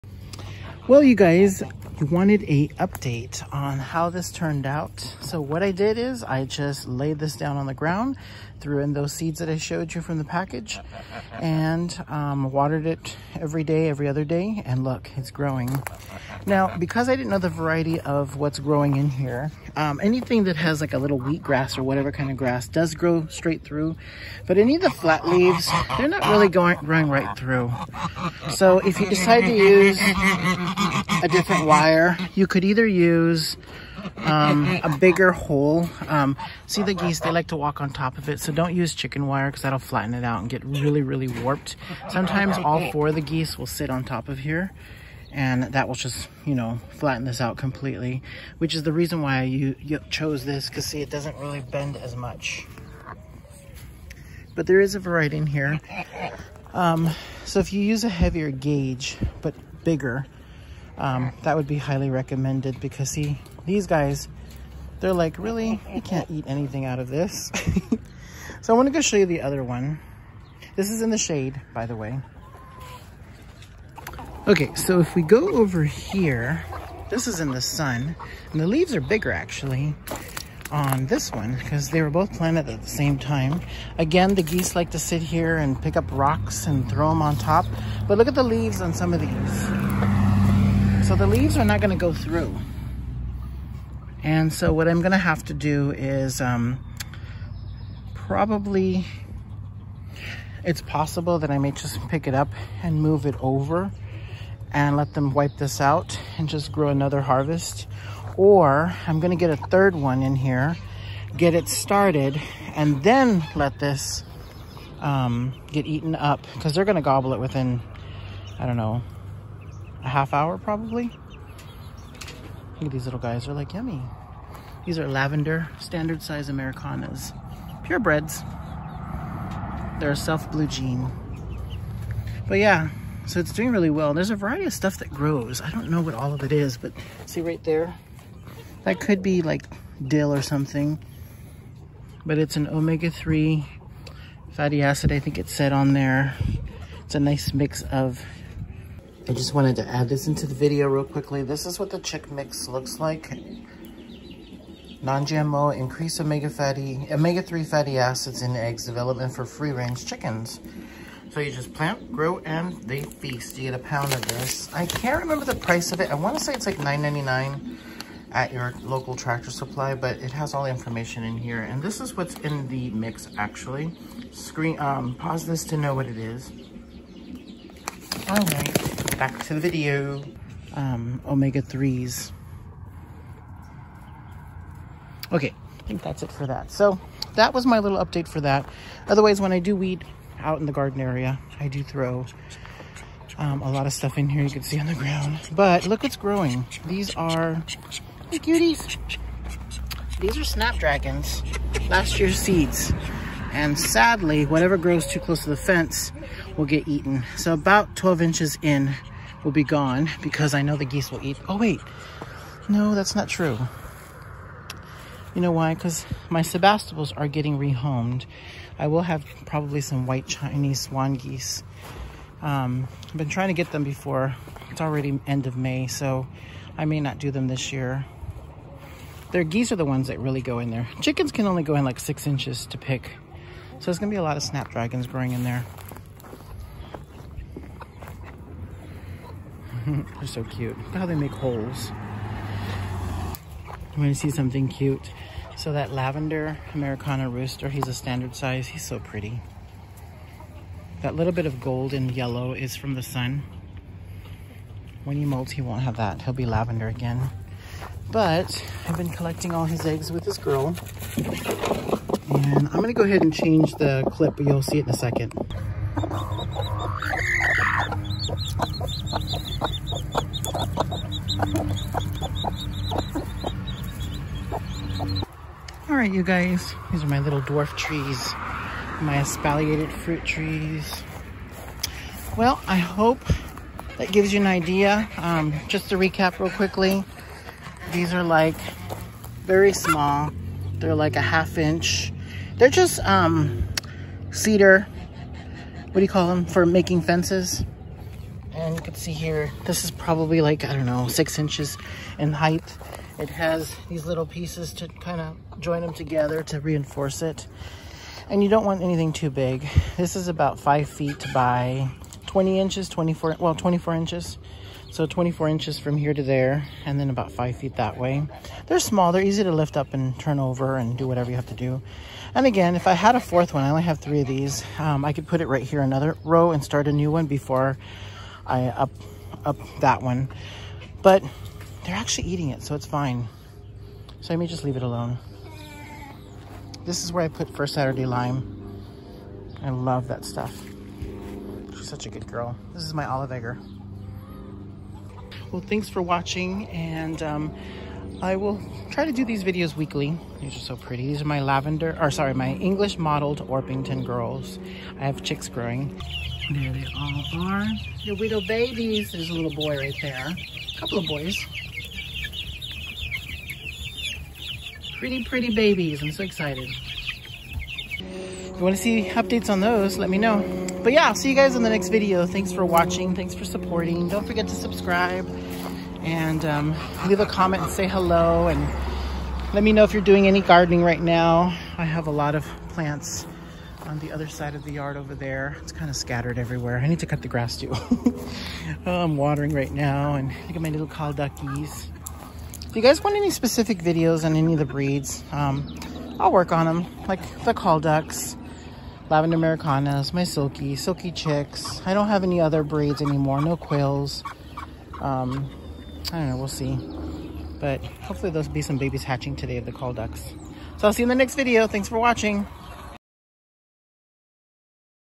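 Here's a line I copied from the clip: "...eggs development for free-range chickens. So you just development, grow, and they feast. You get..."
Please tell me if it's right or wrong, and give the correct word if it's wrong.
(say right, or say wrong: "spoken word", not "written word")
wrong: "plant", not "development".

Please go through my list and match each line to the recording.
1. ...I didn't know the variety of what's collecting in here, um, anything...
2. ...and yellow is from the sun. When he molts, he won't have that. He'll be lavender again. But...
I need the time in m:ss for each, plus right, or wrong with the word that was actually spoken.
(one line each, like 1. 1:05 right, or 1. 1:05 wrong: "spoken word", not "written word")
1. 0:17 wrong: "growing", not "collecting"
2. 4:11 right.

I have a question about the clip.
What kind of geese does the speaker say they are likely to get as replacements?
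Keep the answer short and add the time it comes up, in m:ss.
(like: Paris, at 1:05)
White Chinese swan geese, at 3:40.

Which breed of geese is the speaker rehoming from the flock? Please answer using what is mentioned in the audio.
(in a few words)
Sebastopol.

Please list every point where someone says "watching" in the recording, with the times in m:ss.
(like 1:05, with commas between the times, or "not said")
5:46, 6:12, 6:51.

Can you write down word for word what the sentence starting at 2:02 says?
Look at these little guys, they're like yummy.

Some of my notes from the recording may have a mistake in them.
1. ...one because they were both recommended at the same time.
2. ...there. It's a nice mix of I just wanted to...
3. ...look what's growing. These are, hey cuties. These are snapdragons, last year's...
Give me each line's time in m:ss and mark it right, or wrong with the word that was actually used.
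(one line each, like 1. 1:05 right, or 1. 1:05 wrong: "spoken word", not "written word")
1. 1:21 wrong: "planted", not "recommended"
2. 2:25 right
3. 3:15 right.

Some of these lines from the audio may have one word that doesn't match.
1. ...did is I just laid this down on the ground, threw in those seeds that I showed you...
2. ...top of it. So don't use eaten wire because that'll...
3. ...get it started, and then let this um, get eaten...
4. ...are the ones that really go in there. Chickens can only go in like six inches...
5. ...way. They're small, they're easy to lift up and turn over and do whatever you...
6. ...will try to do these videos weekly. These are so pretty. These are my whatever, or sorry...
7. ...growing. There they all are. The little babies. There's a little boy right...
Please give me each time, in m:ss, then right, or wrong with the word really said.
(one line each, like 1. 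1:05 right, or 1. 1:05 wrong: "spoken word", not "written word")
1. 0:05 right
2. 0:37 wrong: "chicken", not "eaten"
3. 1:51 right
4. 3:49 right
5. 5:17 right
6. 5:48 wrong: "lavender", not "whatever"
7. 5:55 right.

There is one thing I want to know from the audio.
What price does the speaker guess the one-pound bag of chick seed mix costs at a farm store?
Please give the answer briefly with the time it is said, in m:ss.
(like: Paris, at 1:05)
$9.99, at 2:46.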